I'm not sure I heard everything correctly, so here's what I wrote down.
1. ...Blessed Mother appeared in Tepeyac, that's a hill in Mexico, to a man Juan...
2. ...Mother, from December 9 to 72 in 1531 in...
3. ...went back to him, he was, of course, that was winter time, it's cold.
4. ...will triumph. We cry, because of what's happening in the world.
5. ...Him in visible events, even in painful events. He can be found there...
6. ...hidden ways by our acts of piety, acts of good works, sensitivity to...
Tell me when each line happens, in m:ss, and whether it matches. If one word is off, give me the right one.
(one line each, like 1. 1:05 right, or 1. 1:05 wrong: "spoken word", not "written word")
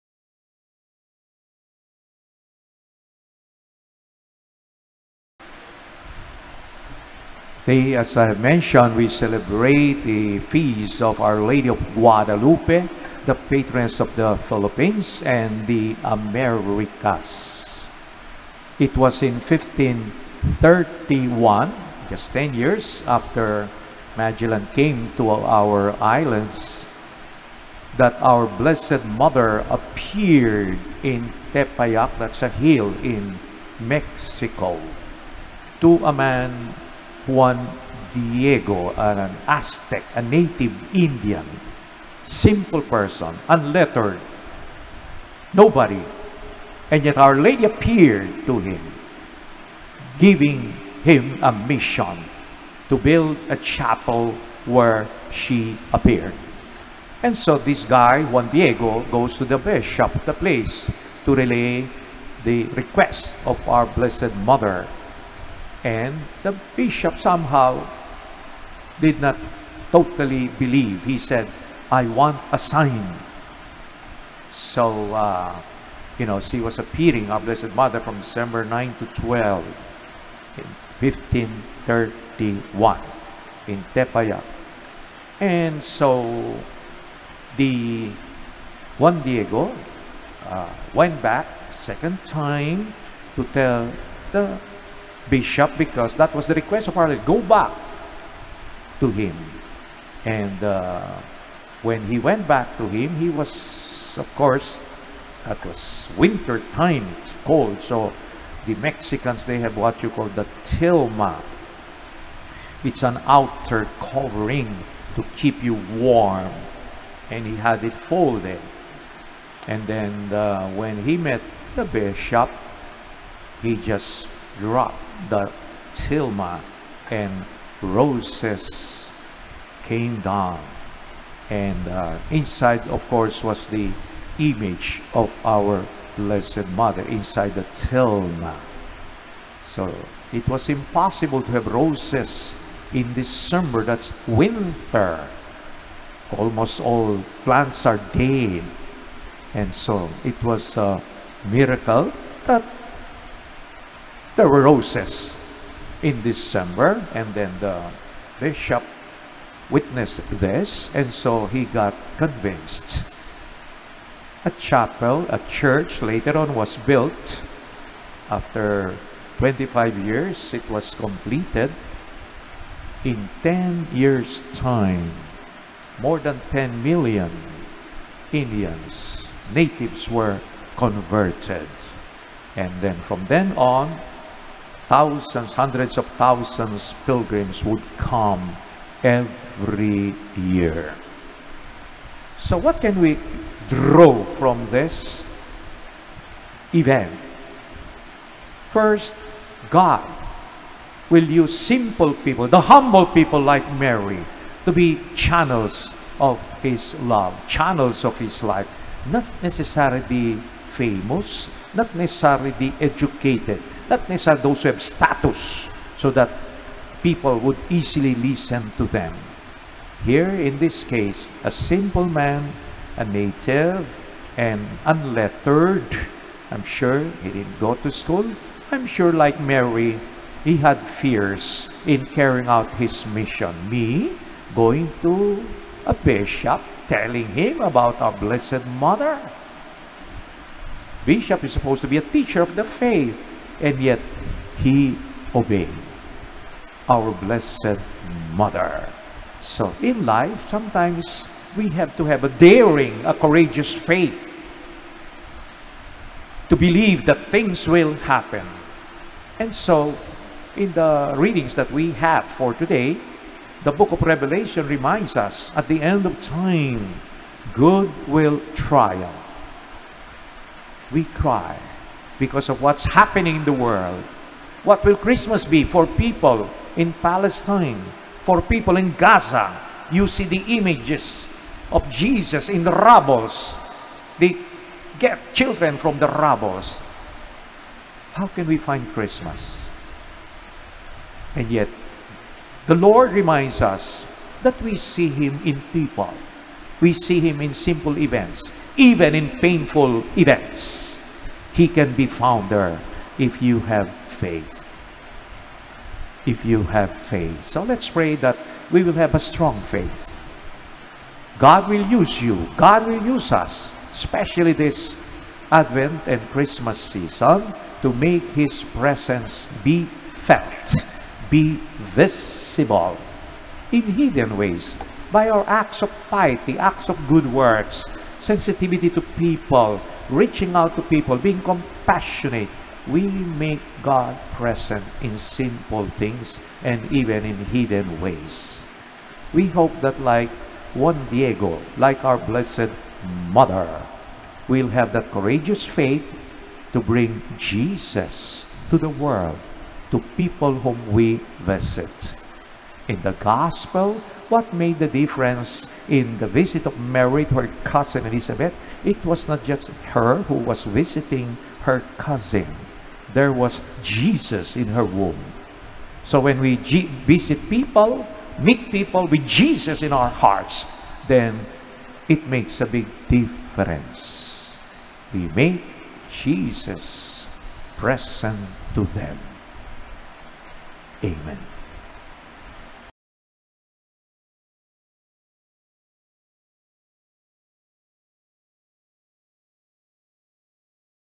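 1. 0:28 right
2. 1:17 wrong: "12", not "72"
3. 1:42 right
4. 4:28 right
5. 4:57 wrong: "simple", not "visible"
6. 5:23 right.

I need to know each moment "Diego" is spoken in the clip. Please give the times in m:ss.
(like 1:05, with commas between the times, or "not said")
0:38, 0:58, 1:29, 5:41.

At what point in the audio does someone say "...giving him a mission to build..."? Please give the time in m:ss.
0:50.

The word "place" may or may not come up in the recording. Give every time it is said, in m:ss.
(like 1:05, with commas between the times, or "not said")
1:00.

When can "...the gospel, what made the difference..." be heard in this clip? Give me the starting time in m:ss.
5:53.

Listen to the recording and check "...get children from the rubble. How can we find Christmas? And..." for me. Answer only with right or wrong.
right.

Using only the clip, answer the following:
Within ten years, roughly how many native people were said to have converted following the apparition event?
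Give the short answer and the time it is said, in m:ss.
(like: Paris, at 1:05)
more than 10 million, at 2:55.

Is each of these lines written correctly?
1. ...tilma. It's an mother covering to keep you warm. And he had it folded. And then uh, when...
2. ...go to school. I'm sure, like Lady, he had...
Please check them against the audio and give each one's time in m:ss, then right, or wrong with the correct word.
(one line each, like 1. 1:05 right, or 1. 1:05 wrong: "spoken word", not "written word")
1. 1:50 wrong: "outer", not "mother"
2. 3:47 wrong: "Mary", not "Lady".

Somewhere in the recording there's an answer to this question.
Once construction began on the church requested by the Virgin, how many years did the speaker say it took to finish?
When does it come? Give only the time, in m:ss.
2:49.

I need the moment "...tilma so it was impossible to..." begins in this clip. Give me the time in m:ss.
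2:17.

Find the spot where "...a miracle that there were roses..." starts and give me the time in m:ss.
2:30.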